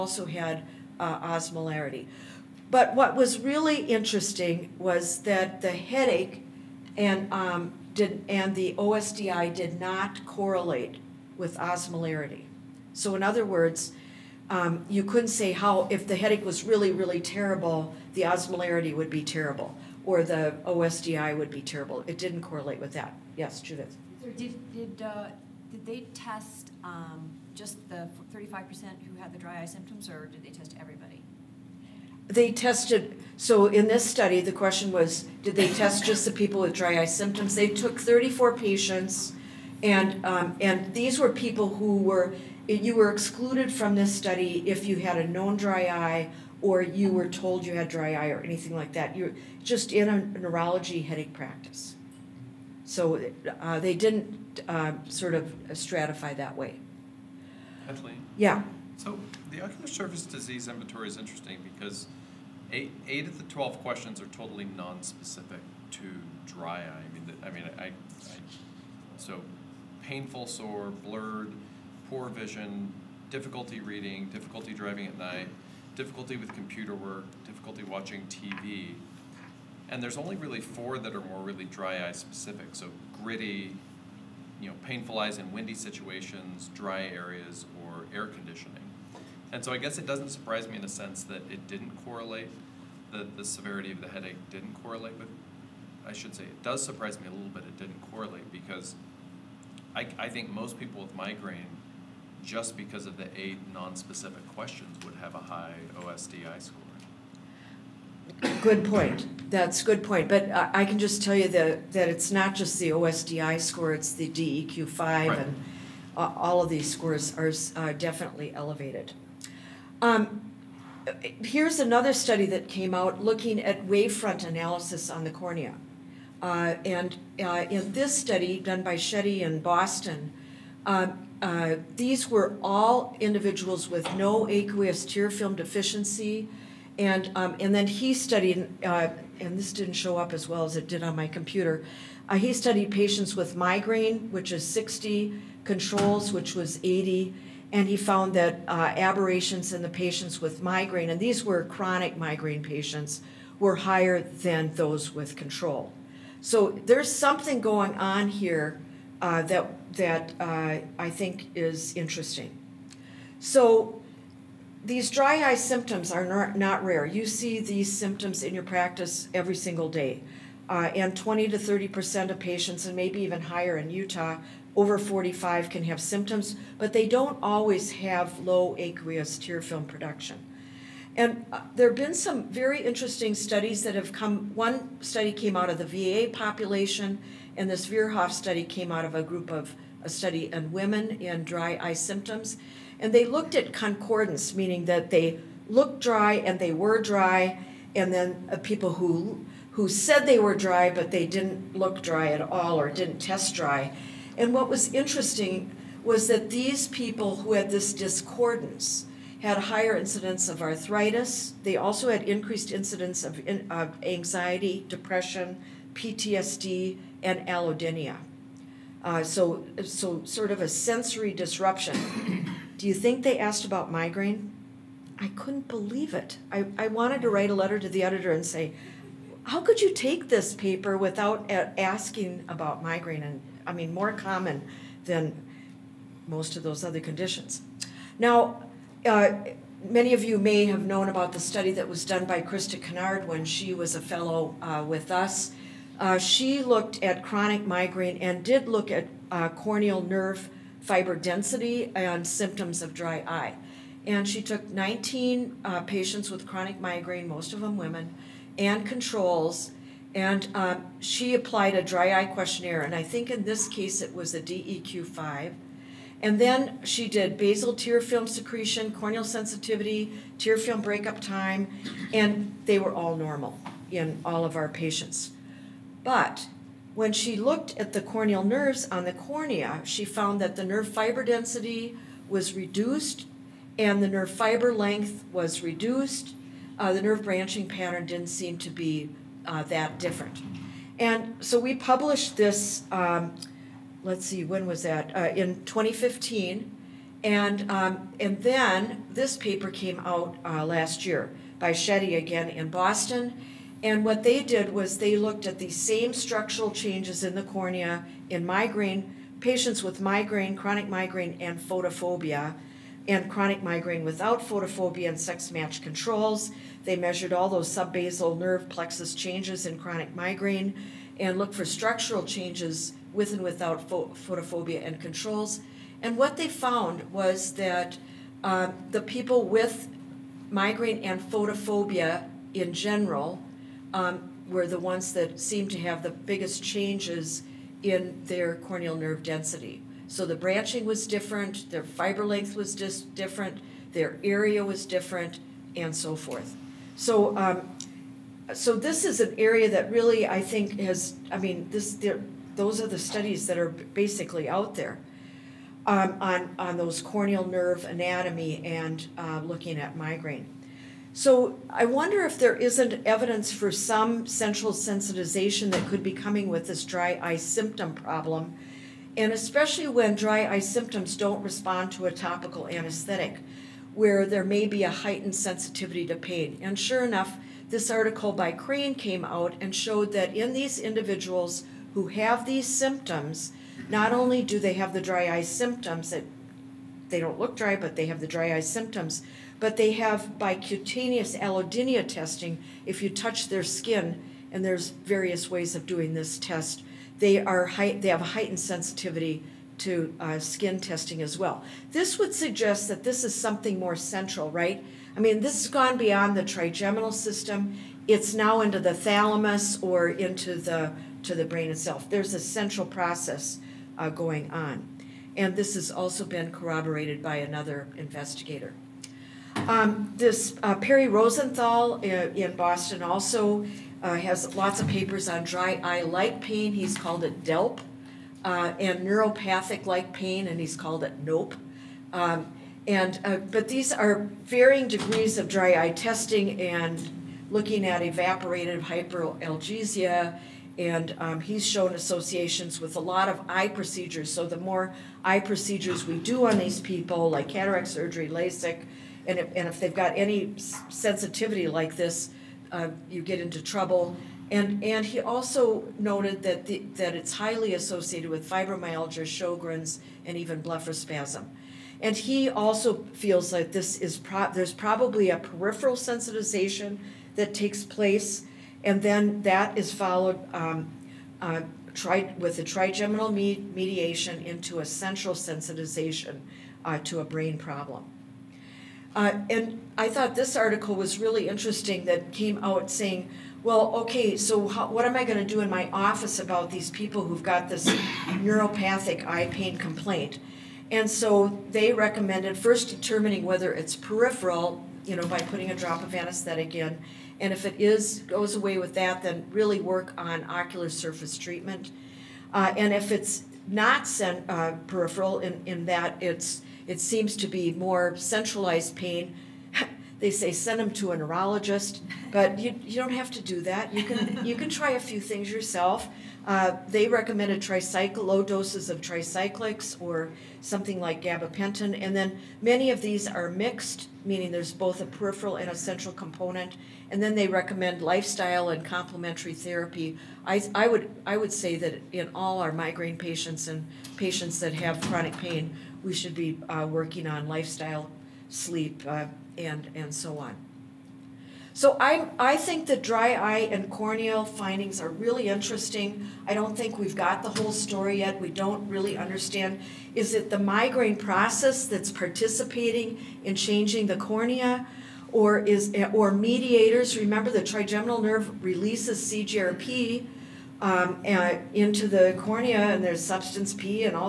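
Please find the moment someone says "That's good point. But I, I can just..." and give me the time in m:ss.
1:49.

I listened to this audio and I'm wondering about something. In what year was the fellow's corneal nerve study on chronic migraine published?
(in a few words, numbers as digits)
2015.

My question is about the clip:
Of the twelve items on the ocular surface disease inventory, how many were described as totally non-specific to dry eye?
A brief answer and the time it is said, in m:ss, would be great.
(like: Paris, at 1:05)
8, at 1:02.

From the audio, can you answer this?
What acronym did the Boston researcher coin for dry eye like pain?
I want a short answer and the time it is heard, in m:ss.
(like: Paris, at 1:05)
DELP, at 7:07.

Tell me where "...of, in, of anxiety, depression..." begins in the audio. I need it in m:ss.
3:33.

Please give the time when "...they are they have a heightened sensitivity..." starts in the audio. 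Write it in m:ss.
6:37.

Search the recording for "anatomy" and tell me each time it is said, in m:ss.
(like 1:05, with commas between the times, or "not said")
5:57.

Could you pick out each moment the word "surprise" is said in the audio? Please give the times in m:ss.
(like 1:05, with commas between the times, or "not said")
1:30, 1:36.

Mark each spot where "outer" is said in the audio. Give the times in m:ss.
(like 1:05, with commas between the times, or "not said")
not said.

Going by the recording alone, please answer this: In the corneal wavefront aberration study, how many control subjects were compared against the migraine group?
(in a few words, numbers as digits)
80.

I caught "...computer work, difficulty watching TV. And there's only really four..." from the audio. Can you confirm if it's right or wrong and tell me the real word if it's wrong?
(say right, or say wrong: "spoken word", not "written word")
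right.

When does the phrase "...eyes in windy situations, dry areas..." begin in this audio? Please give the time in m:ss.
1:25.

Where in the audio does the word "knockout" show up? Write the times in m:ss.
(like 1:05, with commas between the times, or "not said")
not said.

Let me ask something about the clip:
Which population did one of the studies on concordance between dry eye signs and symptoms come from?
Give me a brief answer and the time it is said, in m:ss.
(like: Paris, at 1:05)
VA population, at 3:05.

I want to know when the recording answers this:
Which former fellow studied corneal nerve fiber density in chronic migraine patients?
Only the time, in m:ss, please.
4:02.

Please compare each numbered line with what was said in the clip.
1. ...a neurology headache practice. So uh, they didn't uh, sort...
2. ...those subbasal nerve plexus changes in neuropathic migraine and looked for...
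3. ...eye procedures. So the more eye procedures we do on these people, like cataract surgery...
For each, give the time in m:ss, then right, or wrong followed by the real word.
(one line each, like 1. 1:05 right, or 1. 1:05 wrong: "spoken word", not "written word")
1. 0:50 right
2. 5:17 wrong: "chronic", not "neuropathic"
3. 7:23 right.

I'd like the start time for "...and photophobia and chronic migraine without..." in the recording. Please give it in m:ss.
5:11.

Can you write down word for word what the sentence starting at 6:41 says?
This would suggest that this is something more central, right?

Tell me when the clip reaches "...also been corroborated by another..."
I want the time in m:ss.
6:55.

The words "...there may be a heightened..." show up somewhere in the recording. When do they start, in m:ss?
6:14.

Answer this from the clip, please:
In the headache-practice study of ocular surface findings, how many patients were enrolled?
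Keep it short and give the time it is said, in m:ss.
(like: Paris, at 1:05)
34, at 0:37.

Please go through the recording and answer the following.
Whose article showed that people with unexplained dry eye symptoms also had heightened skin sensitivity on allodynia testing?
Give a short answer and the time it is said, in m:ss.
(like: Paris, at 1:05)
Crane, at 6:18.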